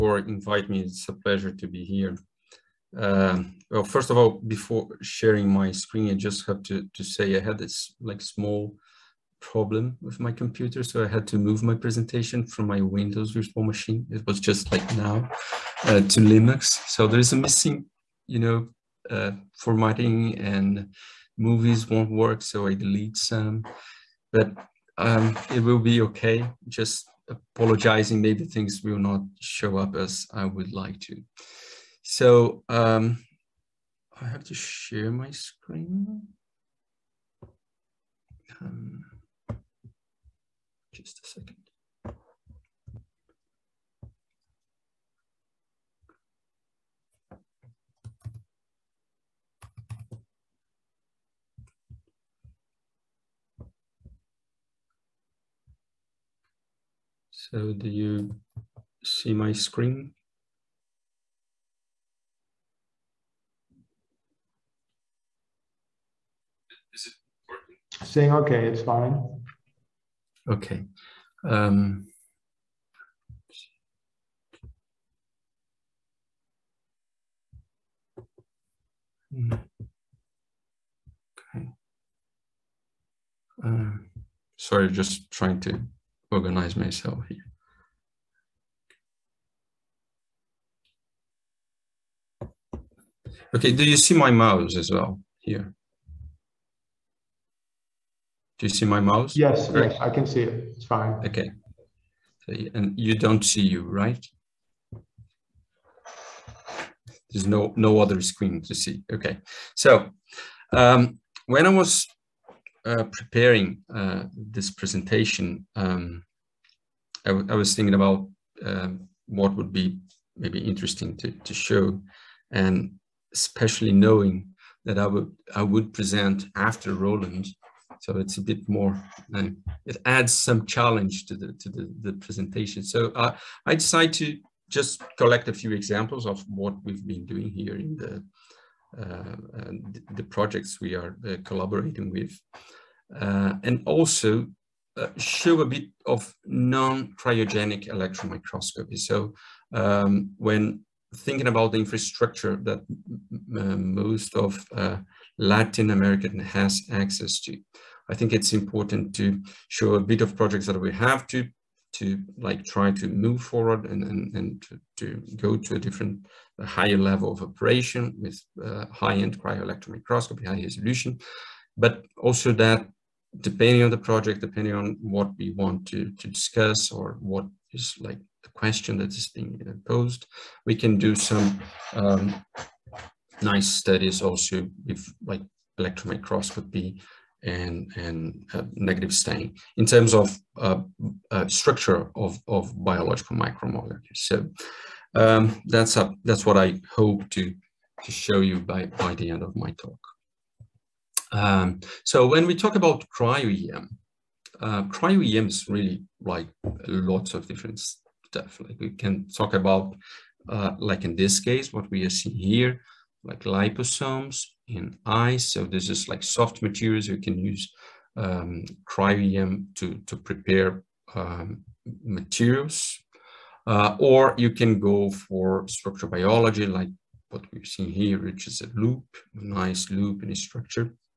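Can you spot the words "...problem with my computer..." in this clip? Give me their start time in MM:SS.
00:09.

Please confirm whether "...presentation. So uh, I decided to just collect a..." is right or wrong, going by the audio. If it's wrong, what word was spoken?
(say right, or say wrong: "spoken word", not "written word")
right.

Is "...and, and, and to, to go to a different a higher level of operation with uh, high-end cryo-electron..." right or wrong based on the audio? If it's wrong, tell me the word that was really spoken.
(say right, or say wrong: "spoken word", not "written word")
right.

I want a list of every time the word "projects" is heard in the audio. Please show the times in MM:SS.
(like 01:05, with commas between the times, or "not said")
02:20, 02:40, 02:53.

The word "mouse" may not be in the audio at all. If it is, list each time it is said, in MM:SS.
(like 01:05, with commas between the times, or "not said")
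01:34, 01:39.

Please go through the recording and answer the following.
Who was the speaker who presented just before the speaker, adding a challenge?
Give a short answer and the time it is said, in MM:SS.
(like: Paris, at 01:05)
Roland, at 02:06.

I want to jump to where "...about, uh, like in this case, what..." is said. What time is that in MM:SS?
03:29.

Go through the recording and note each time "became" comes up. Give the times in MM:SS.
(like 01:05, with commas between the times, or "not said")
not said.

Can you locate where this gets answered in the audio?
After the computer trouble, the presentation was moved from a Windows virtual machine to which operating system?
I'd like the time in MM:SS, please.
00:16.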